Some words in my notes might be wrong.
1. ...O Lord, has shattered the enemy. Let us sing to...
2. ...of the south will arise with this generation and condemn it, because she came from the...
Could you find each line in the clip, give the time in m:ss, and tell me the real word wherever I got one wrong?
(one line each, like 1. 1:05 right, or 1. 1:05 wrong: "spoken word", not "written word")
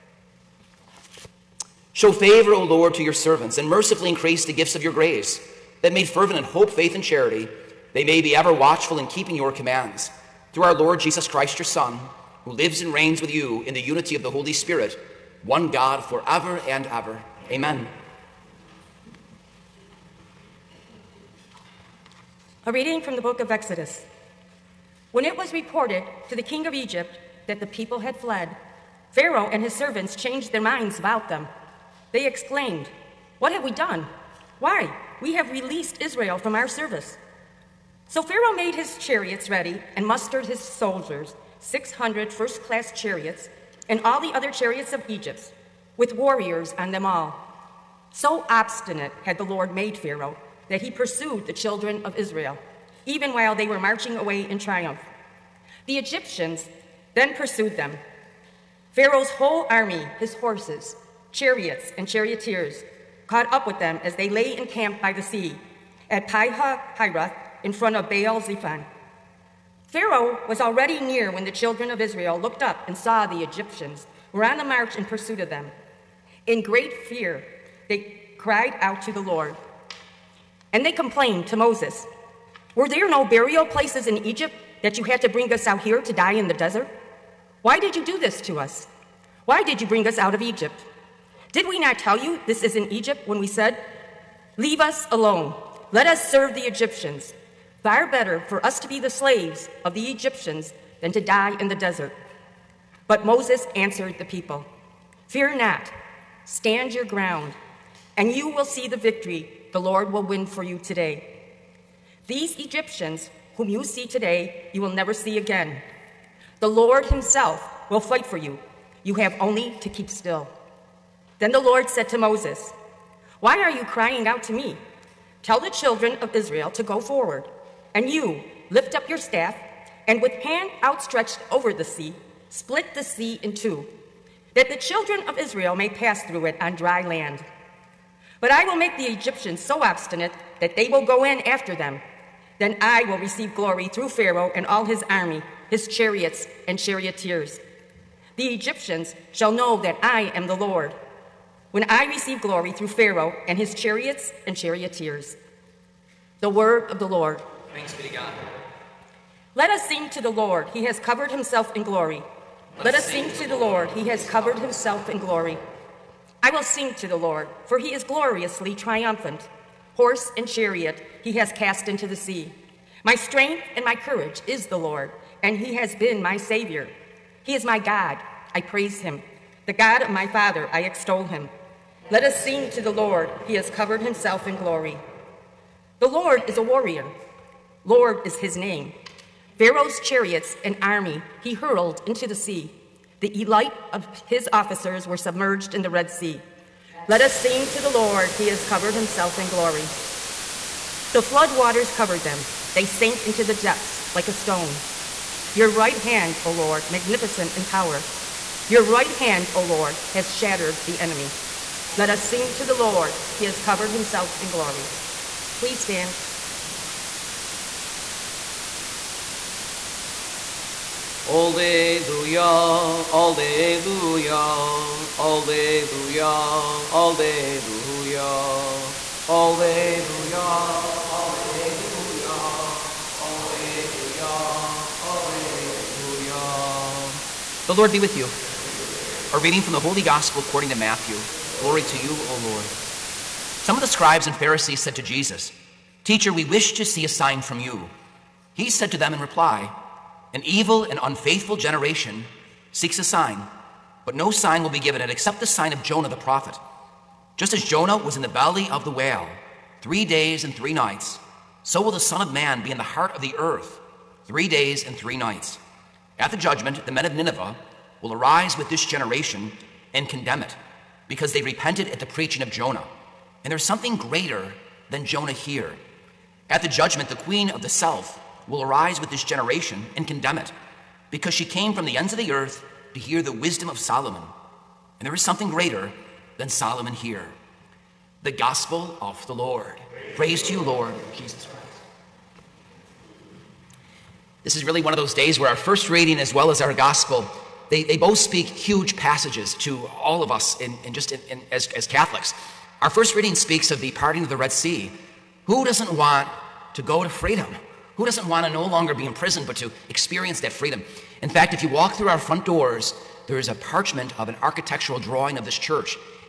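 1. 3:29 right
2. 4:37 right.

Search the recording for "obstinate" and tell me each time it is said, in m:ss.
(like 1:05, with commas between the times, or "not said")
0:48, 2:19.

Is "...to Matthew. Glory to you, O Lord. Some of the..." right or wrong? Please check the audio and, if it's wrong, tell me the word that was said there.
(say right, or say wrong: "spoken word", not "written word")
right.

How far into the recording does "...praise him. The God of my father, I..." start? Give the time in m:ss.
2:58.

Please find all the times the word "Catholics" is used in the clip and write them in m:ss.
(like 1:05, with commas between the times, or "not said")
5:01.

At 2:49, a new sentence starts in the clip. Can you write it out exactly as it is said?
Horse and chariot he has cast into the sea.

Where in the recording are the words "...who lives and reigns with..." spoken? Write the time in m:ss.
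0:12.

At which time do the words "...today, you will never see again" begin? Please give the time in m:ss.
1:54.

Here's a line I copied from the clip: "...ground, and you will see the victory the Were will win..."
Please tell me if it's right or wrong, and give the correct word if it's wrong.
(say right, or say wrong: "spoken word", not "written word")
wrong: "Lord", not "Were".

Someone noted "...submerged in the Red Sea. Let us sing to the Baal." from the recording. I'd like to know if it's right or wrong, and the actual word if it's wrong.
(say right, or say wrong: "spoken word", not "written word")
wrong: "Lord", not "Baal".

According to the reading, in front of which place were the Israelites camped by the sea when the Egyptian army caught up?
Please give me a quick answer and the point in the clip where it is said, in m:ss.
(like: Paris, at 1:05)
Baal Zephon, at 1:08.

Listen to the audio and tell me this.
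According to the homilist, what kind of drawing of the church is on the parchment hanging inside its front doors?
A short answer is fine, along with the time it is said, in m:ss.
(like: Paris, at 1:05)
architectural drawing, at 5:14.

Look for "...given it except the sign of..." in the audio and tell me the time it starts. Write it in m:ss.
4:14.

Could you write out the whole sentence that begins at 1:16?
In great fear, they cried out to the Lord.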